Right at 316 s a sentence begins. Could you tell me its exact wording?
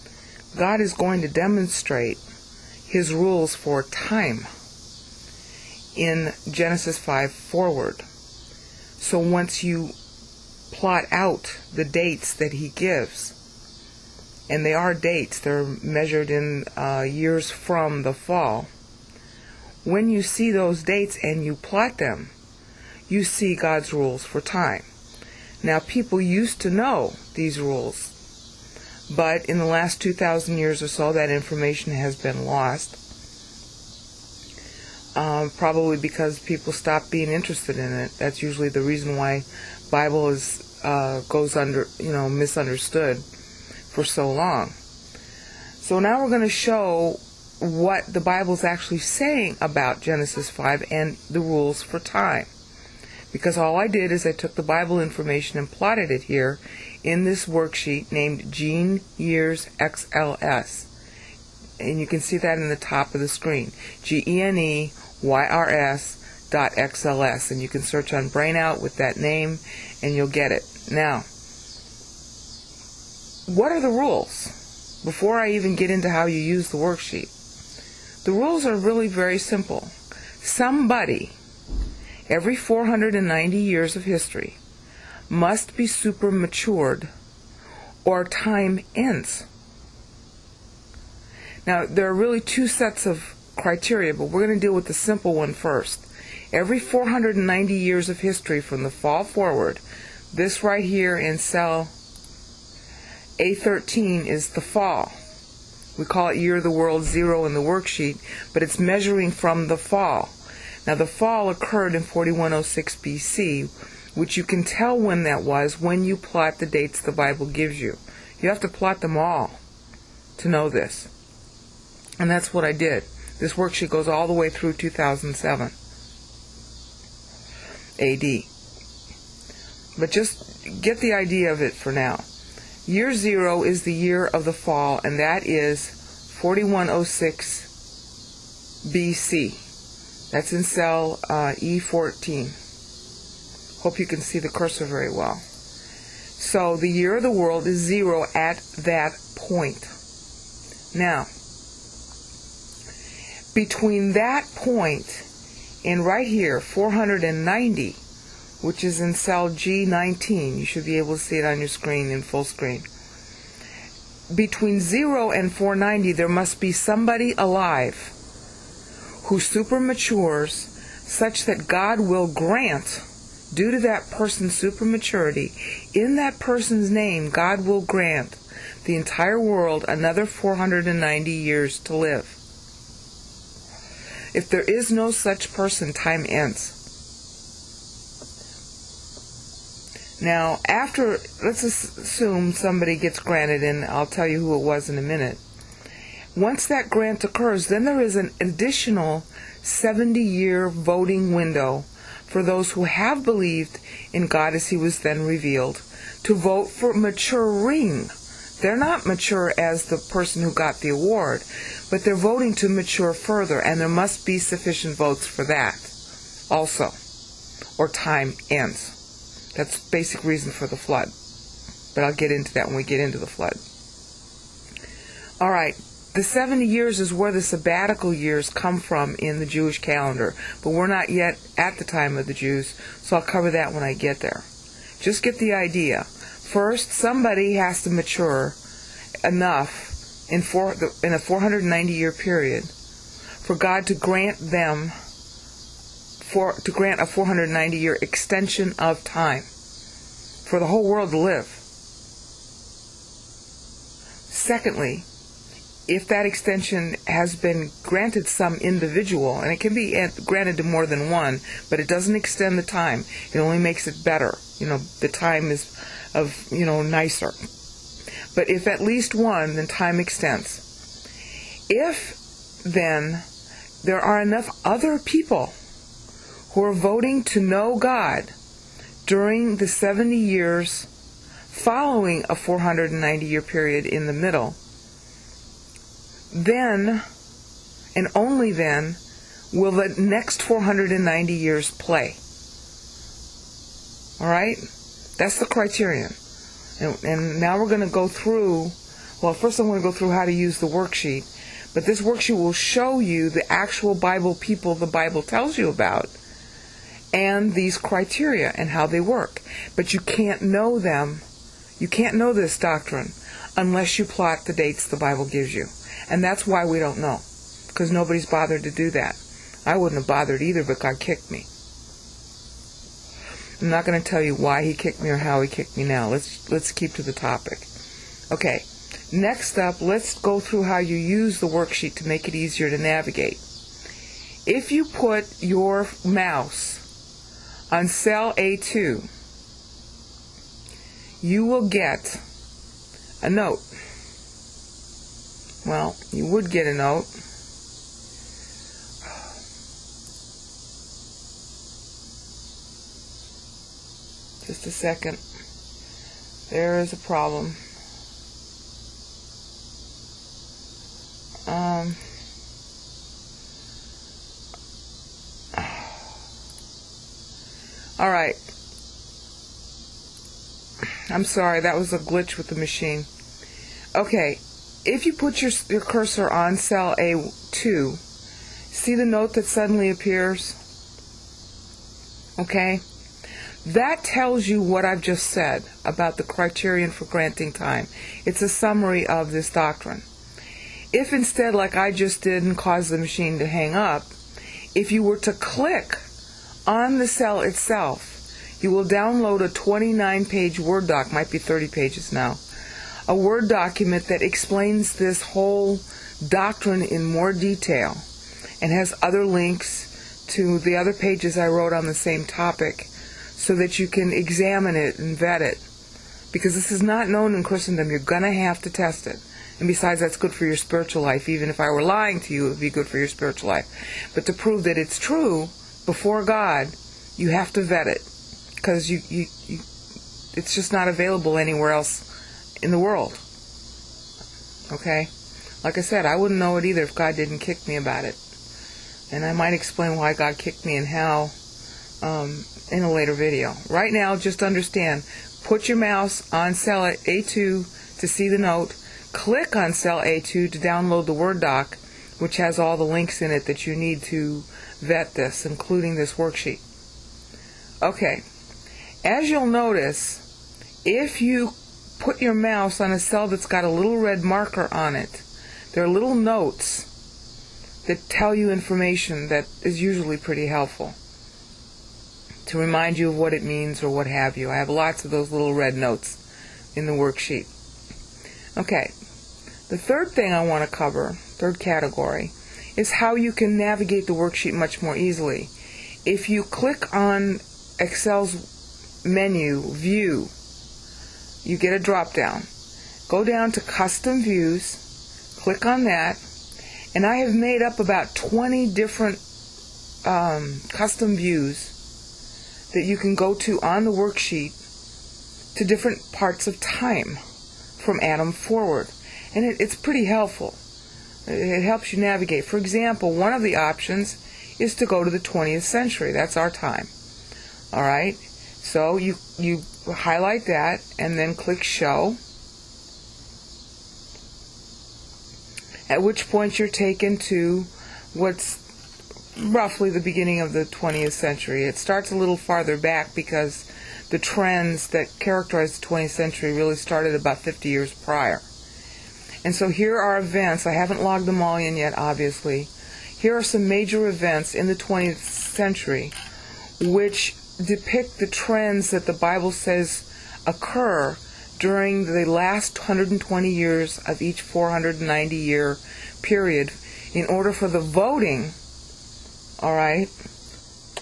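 And that's why we don't know, because nobody's bothered to do that.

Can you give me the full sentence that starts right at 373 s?
Okay, if you put your, your cursor on cell A2, see the note that suddenly appears?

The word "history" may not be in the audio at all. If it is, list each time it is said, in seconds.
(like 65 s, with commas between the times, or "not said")
84 s, 98 s.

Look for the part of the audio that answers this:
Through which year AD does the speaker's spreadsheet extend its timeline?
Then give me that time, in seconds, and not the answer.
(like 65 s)
124 s.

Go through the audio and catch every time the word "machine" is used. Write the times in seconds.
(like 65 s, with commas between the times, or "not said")
372 s, 392 s.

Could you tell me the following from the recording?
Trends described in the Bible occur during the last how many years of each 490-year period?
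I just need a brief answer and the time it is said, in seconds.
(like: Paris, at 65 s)
120, at 552 s.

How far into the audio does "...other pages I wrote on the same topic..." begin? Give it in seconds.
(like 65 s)
410 s.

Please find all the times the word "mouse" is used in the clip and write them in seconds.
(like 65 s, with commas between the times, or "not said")
336 s, 445 s, 462 s.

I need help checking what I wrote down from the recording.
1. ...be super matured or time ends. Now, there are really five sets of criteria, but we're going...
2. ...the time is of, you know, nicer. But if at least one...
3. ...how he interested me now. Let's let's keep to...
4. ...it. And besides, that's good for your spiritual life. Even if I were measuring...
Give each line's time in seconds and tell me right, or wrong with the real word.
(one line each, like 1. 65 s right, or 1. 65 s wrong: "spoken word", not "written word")
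1. 85 s wrong: "two", not "five"
2. 264 s right
3. 325 s wrong: "kicked", not "interested"
4. 419 s wrong: "lying", not "measuring".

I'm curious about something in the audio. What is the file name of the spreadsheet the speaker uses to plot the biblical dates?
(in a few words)
Gene Years XLS.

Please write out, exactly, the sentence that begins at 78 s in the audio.
The rules are really very simple.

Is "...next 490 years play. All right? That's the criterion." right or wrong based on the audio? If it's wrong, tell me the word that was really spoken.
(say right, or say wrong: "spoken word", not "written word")
right.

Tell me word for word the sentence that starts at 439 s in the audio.
And I might explain why God kicked me and how um, in a later video.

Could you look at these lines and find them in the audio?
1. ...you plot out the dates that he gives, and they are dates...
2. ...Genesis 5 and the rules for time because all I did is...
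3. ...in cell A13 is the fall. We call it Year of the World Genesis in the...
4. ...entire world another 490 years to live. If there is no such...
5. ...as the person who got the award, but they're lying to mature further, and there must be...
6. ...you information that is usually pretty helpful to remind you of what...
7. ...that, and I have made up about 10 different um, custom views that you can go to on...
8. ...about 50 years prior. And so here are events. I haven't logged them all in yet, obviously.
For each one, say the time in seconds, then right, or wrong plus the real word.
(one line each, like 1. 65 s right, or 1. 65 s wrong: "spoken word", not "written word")
1. 9 s right
2. 50 s right
3. 101 s wrong: "Zero", not "Genesis"
4. 178 s right
5. 209 s wrong: "voting", not "lying"
6. 468 s right
7. 495 s wrong: "20", not "10"
8. 537 s right.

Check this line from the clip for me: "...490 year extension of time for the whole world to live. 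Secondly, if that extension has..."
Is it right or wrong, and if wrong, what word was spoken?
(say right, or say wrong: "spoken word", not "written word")
right.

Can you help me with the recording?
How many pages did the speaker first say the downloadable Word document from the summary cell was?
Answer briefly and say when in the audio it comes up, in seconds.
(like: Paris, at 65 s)
29, at 399 s.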